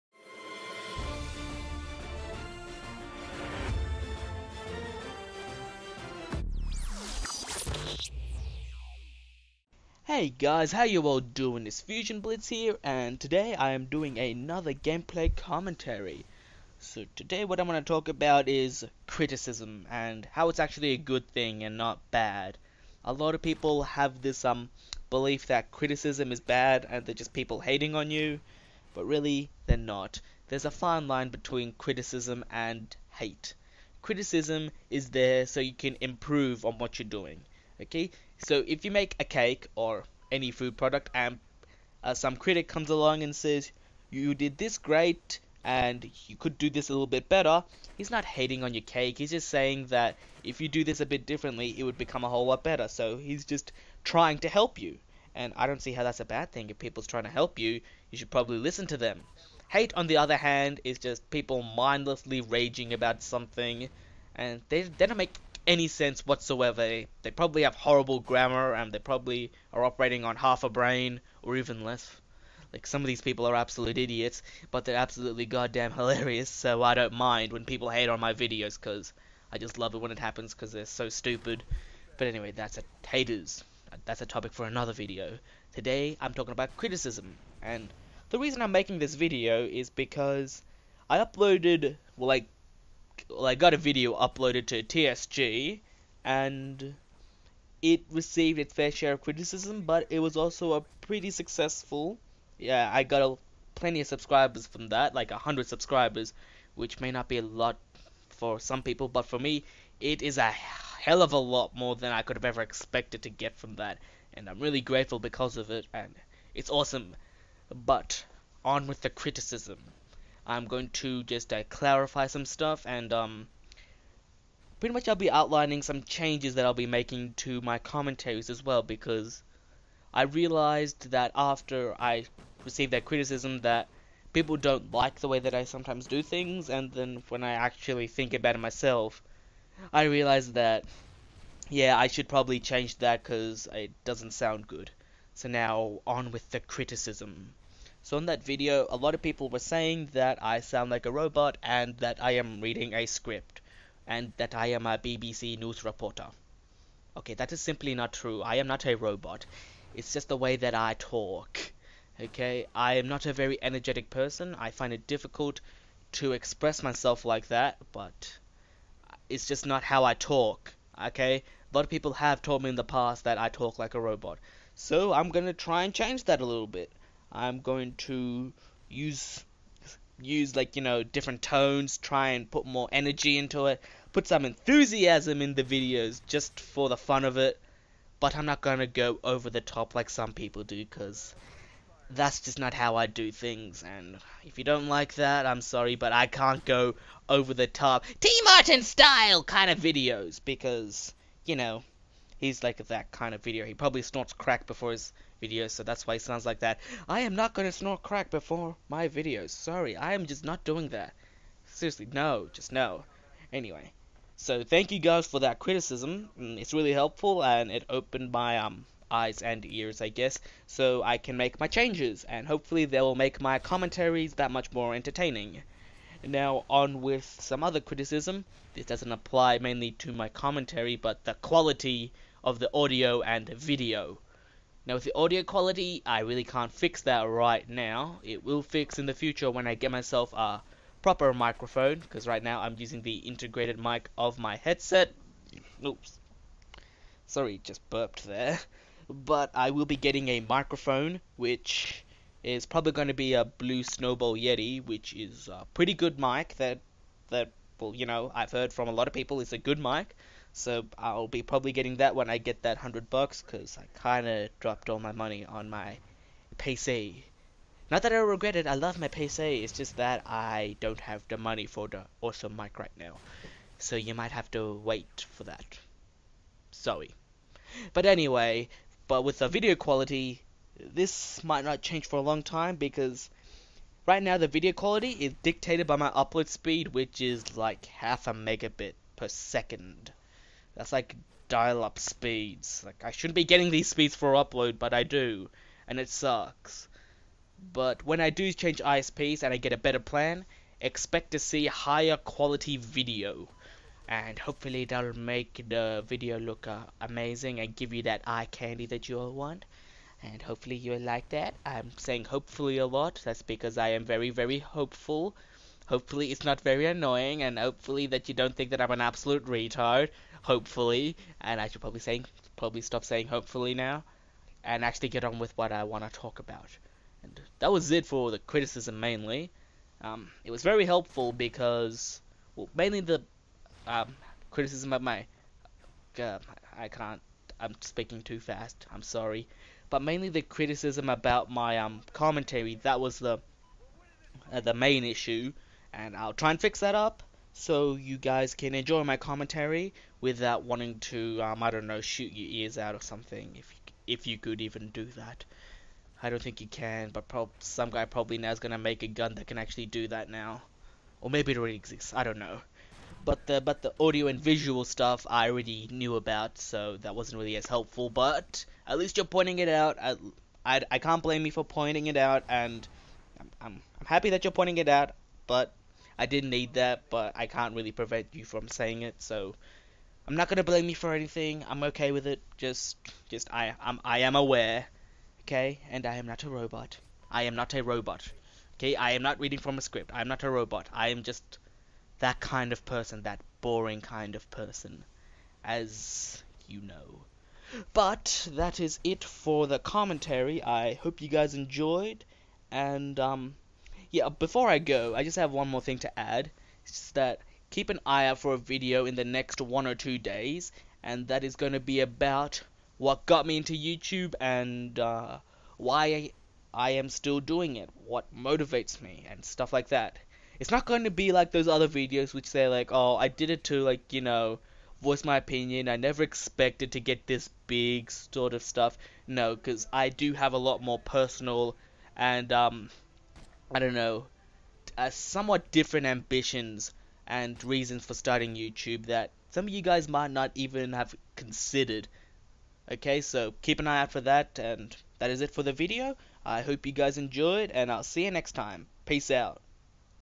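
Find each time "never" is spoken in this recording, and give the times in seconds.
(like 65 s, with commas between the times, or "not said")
425 s.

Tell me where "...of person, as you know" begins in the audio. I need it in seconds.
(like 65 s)
394 s.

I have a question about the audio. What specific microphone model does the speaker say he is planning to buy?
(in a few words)
Blue Snowball Yeti.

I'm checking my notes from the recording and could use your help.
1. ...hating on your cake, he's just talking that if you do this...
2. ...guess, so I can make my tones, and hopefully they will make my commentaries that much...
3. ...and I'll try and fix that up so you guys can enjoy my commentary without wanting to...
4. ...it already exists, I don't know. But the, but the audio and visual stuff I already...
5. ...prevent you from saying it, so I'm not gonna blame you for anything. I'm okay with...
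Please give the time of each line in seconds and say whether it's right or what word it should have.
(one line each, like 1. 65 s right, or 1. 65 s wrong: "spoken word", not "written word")
1. 48 s wrong: "saying", not "talking"
2. 220 s wrong: "changes", not "tones"
3. 345 s right
4. 361 s right
5. 377 s right.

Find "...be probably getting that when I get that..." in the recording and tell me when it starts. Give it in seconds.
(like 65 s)
261 s.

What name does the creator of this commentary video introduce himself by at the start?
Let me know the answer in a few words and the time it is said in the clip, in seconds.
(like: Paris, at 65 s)
Fusion Blitz, at 11 s.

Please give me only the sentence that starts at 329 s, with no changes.
Um, it was very helpful because, well, mainly the um, criticism of my.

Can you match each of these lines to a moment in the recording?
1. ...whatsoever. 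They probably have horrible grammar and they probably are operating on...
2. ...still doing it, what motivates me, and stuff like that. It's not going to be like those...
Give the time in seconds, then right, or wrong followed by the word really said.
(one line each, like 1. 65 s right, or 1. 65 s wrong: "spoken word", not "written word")
1. 66 s right
2. 417 s right.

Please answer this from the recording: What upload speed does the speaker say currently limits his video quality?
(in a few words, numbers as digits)
0.5 megabits per second.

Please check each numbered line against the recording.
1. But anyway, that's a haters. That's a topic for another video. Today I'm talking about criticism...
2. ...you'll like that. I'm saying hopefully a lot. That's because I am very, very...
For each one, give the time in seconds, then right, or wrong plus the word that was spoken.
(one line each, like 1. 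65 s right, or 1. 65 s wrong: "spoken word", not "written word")
1. 82 s right
2. 310 s right.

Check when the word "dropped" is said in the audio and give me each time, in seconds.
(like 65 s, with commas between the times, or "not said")
264 s.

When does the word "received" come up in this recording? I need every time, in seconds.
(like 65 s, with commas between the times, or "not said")
98 s, 132 s.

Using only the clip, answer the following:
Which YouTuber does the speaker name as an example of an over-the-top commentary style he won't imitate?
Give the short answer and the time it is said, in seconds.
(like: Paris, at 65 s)
T Martin, at 198 s.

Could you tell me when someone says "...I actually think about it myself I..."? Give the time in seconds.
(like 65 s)
137 s.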